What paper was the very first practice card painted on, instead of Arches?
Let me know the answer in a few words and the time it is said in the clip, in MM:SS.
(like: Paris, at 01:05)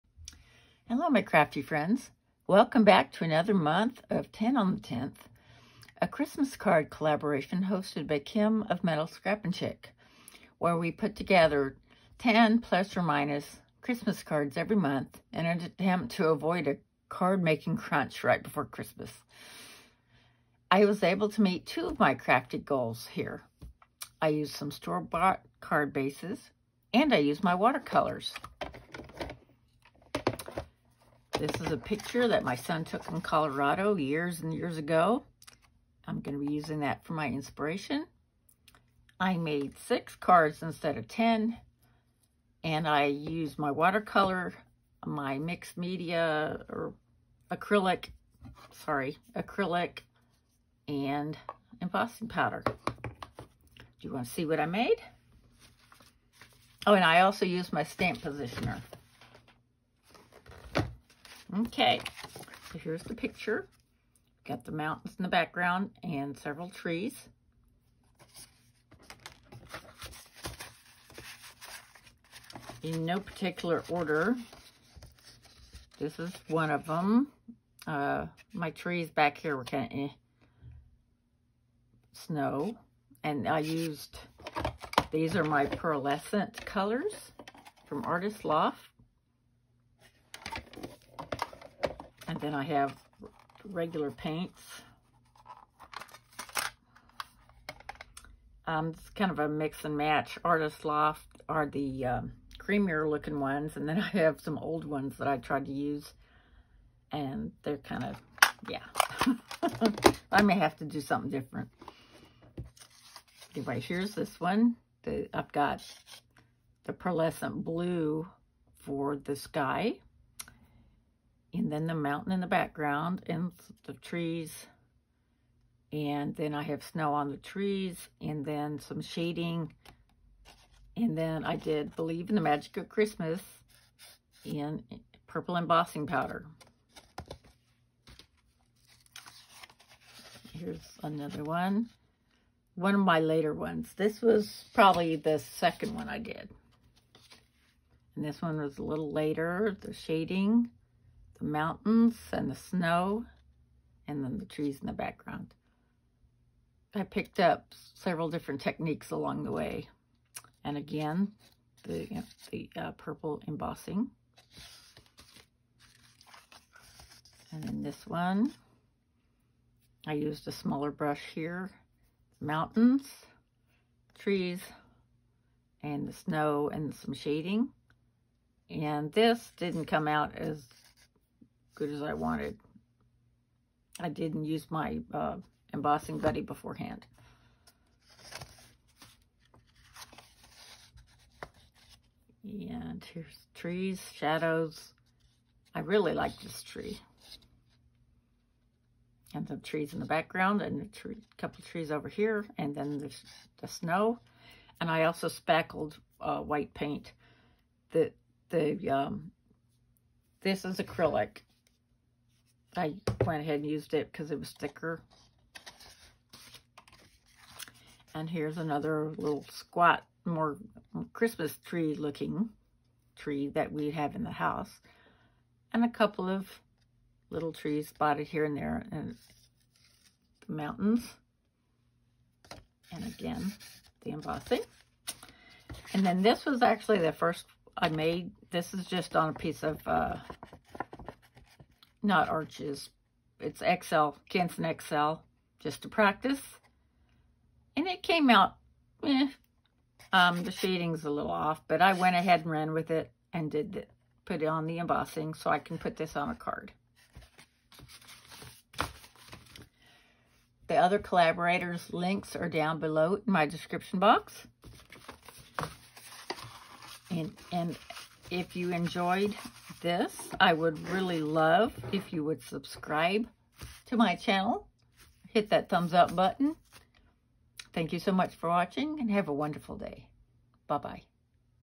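Canson XL, at 04:04.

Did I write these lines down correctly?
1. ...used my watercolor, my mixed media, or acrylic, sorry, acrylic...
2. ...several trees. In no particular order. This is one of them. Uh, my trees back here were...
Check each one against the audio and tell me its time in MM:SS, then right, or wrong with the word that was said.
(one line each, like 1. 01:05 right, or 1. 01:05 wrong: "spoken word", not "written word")
1. 00:43 right
2. 01:06 right.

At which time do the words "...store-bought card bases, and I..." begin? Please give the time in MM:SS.
00:24.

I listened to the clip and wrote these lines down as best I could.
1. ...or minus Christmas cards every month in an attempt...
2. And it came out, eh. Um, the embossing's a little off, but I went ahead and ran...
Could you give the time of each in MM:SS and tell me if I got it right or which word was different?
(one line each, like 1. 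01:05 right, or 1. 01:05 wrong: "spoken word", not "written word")
1. 00:12 right
2. 04:07 wrong: "shading", not "embossing".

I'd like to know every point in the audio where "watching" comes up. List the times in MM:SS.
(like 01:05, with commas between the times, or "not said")
04:38.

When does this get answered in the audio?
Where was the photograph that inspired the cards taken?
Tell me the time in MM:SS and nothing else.
00:33.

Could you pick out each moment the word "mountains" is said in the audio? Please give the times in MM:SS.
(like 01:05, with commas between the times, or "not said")
01:04, 02:01, 02:31, 02:52, 03:50.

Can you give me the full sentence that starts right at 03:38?
And here's another little squat, more Christmas tree looking tree that we have in the house.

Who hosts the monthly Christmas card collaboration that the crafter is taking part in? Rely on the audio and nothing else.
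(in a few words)
Kim.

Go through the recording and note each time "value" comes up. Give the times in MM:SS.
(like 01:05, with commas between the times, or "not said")
not said.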